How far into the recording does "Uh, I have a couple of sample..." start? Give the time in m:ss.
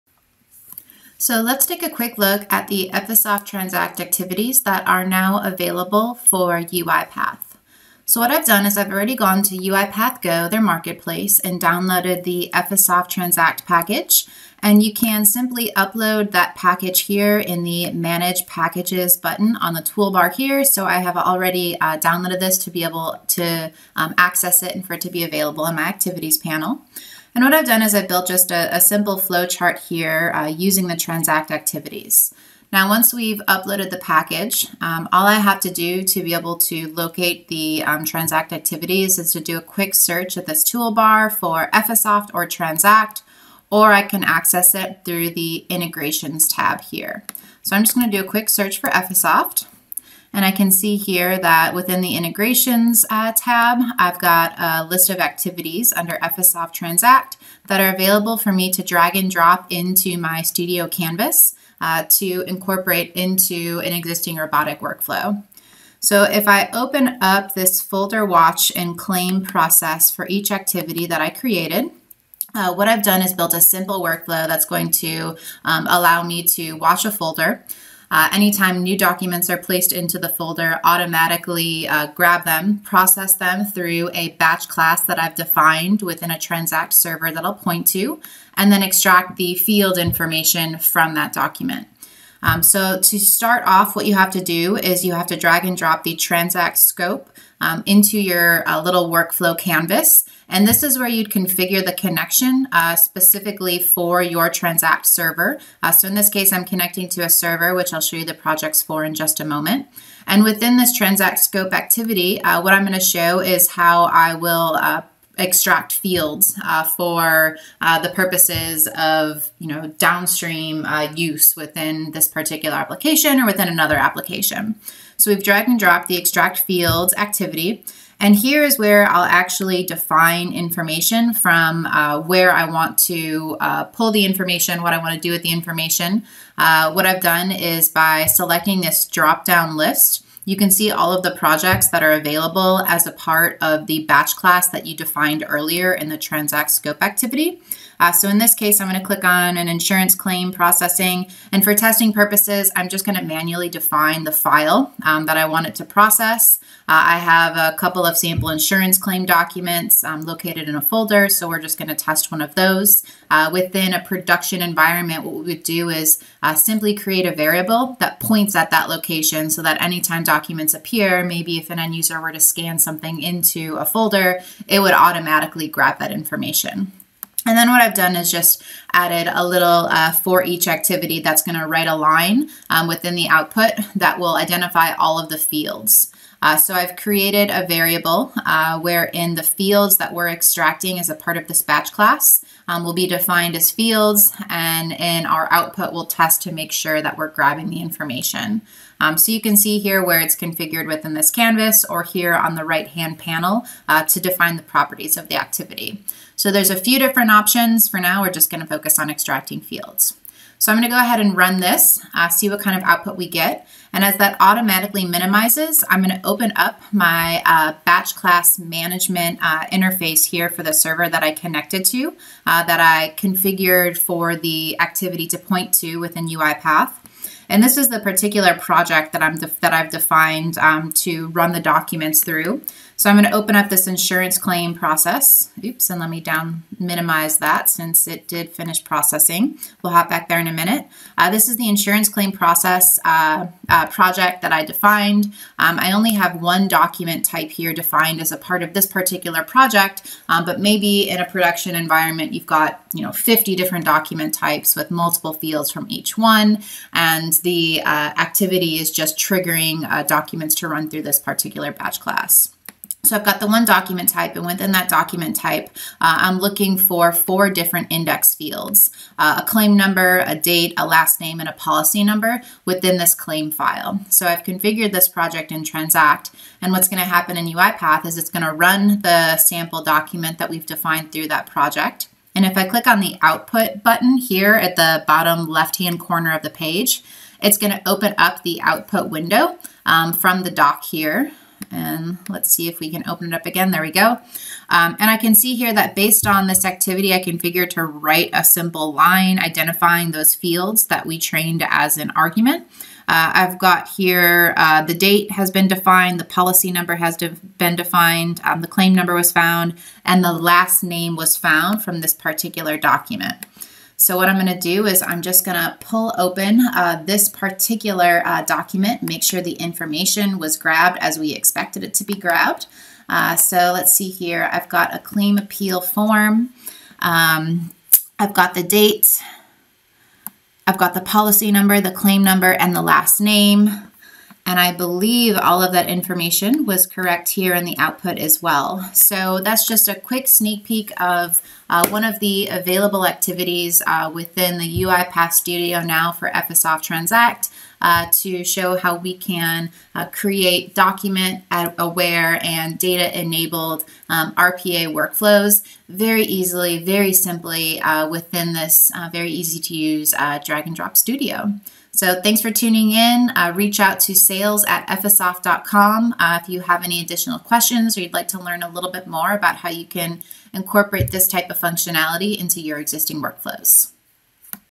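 2:36.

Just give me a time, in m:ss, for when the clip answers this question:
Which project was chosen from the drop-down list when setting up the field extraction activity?
2:29.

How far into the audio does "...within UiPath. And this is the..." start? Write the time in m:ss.
3:45.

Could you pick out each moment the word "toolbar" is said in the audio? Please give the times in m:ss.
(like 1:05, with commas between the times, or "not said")
0:19, 0:40.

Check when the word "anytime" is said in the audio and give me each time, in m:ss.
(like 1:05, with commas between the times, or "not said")
1:18, 2:49.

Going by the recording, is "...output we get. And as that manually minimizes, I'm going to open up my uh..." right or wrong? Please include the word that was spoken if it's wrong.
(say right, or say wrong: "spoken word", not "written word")
wrong: "automatically", not "manually".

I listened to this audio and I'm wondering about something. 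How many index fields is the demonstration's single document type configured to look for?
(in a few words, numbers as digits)
4.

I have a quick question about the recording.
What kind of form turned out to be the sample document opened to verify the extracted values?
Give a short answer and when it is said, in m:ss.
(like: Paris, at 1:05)
Claim appeal form, at 5:24.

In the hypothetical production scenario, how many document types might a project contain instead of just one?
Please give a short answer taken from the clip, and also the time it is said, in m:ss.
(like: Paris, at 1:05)
50, at 4:13.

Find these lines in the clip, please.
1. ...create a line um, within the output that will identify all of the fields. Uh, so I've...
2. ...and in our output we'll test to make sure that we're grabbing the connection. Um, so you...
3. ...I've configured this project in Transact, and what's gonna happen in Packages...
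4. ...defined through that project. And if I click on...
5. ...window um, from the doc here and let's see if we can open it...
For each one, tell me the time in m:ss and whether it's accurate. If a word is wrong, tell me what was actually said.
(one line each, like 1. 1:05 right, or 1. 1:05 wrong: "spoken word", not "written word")
1. 3:01 wrong: "write", not "create"
2. 3:14 wrong: "information", not "connection"
3. 4:34 wrong: "UiPath", not "Packages"
4. 4:40 right
5. 4:49 right.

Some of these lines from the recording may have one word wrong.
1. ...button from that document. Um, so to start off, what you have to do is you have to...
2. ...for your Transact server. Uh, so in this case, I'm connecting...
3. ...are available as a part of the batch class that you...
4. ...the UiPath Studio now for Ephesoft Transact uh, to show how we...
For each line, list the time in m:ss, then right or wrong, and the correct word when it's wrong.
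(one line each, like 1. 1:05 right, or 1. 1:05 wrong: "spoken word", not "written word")
1. 1:29 wrong: "information", not "button"
2. 1:43 right
3. 2:22 right
4. 5:44 right.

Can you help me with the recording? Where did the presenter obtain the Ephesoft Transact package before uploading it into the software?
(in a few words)
UiPath Go.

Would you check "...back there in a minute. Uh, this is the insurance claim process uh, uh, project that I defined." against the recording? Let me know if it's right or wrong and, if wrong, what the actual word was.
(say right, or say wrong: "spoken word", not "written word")
right.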